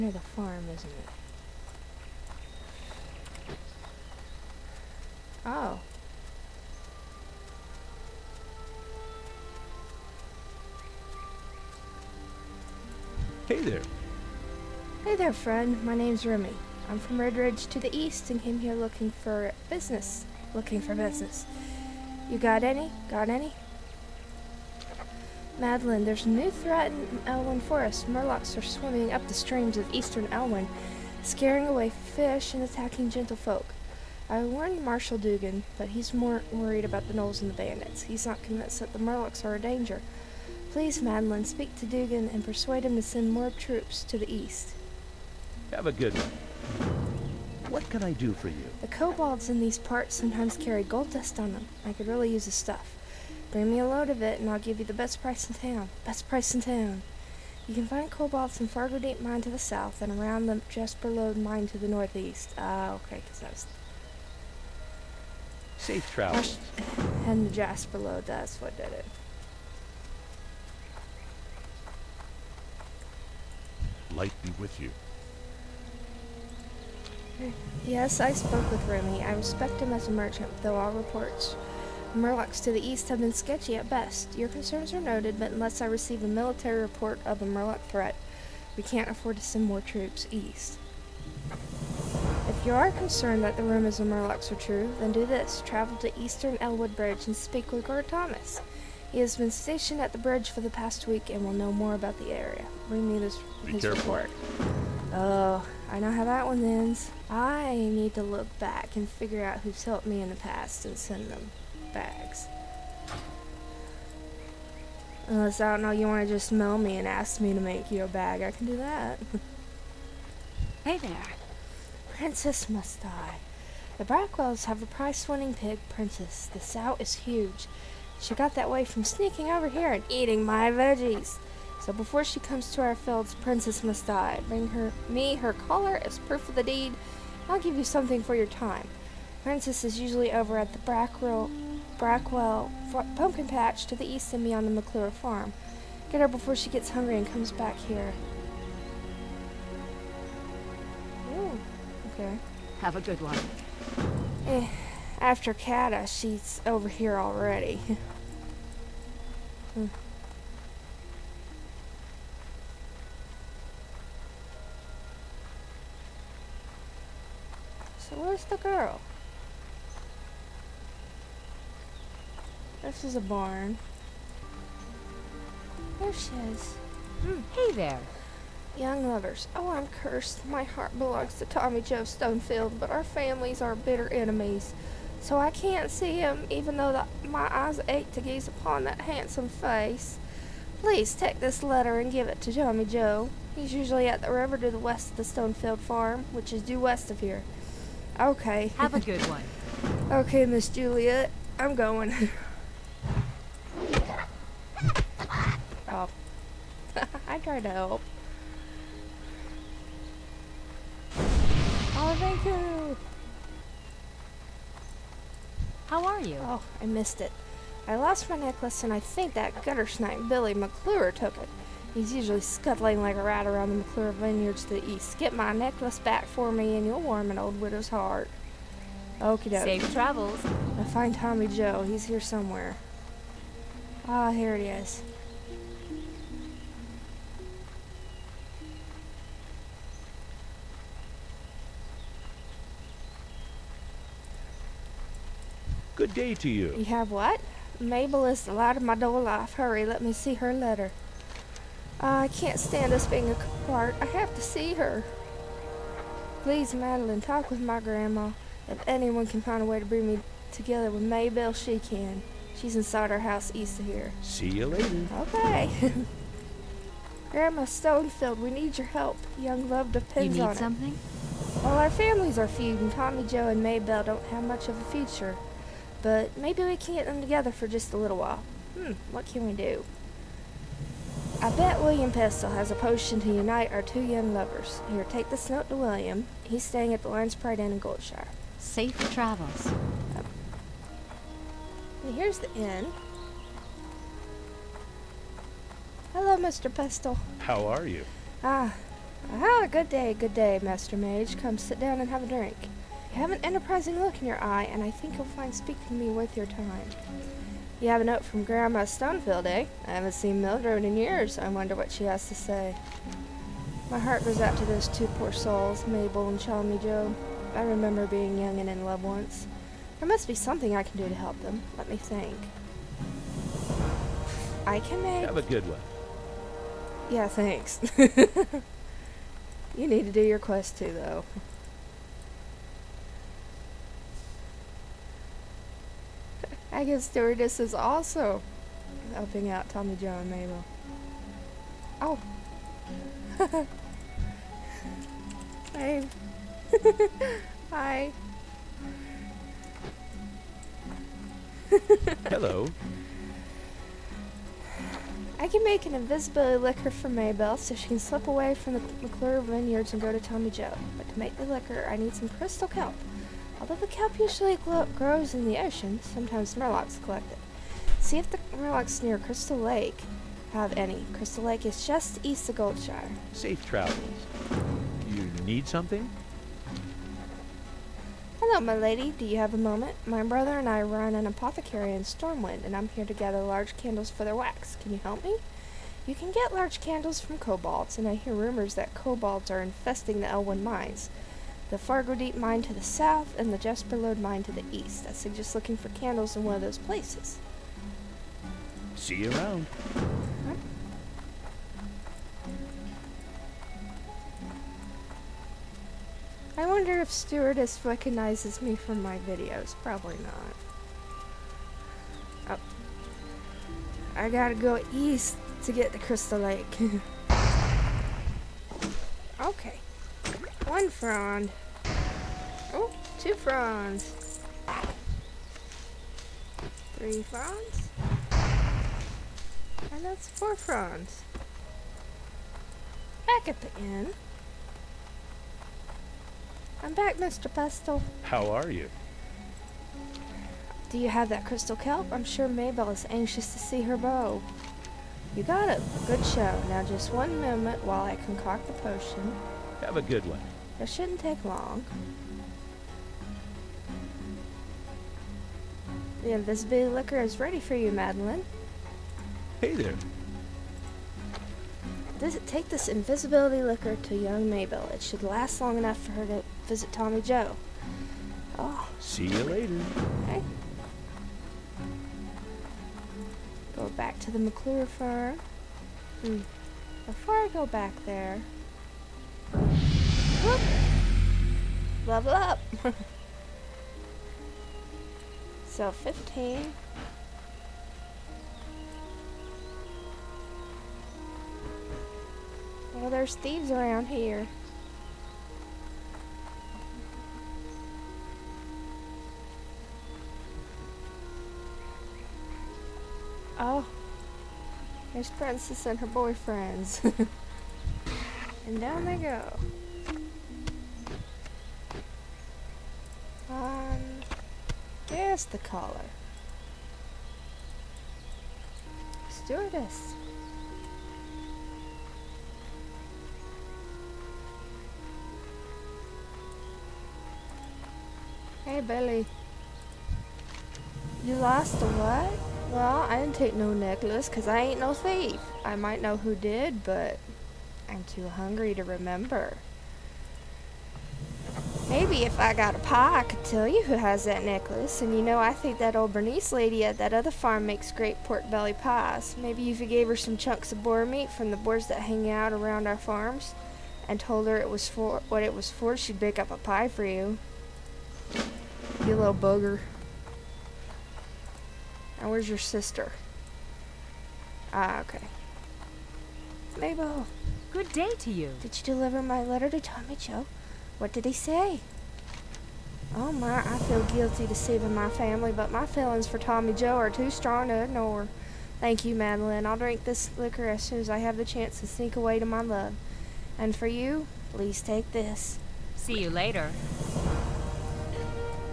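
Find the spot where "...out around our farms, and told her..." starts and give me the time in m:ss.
9:12.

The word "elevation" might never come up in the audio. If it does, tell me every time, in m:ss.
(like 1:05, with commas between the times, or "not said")
not said.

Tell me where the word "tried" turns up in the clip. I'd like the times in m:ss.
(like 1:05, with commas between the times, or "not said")
3:27.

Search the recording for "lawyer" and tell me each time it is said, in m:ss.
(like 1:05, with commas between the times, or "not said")
not said.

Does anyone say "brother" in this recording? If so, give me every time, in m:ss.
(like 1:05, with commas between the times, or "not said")
6:20.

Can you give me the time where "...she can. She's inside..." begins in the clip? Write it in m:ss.
4:21.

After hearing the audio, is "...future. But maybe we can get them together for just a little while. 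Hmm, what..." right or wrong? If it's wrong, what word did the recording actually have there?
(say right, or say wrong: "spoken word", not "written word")
right.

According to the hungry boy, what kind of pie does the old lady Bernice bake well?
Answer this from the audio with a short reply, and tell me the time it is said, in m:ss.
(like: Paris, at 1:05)
Pork belly pies, at 9:08.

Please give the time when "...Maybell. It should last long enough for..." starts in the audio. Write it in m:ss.
7:44.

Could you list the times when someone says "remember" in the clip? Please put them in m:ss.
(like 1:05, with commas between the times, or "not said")
5:17, 8:58.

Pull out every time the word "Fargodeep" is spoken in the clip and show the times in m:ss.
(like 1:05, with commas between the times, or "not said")
0:58, 6:31.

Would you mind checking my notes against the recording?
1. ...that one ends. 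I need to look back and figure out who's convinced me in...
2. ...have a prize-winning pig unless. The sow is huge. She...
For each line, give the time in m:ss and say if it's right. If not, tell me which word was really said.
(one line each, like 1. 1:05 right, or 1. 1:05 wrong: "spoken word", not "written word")
1. 1:46 wrong: "helped", not "convinced"
2. 2:04 wrong: "princess", not "unless".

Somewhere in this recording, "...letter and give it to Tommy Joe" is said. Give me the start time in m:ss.
3:11.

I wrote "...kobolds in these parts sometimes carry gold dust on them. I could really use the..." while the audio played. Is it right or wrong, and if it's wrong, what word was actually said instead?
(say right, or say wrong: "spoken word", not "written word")
right.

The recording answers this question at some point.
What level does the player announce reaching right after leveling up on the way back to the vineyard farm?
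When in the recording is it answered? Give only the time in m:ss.
8:05.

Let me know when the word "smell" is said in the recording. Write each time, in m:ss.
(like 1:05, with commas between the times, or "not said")
1:56.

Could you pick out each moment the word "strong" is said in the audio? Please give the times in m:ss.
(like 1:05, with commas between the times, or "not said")
9:37.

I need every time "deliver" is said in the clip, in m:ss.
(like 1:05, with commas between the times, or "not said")
9:28.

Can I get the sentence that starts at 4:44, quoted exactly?
Here, take this note to William.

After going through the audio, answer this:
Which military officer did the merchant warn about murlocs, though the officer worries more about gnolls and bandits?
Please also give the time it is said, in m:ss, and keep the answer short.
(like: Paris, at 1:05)
Marshal Dugan, at 0:34.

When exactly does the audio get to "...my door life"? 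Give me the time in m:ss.
4:08.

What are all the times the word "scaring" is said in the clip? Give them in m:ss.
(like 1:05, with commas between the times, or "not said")
0:31.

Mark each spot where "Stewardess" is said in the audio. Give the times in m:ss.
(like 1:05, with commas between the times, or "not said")
5:37, 6:47, 8:39.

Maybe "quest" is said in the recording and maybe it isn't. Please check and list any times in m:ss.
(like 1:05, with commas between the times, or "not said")
5:30.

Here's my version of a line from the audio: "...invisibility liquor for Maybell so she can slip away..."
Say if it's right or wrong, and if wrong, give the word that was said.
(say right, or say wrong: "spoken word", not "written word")
right.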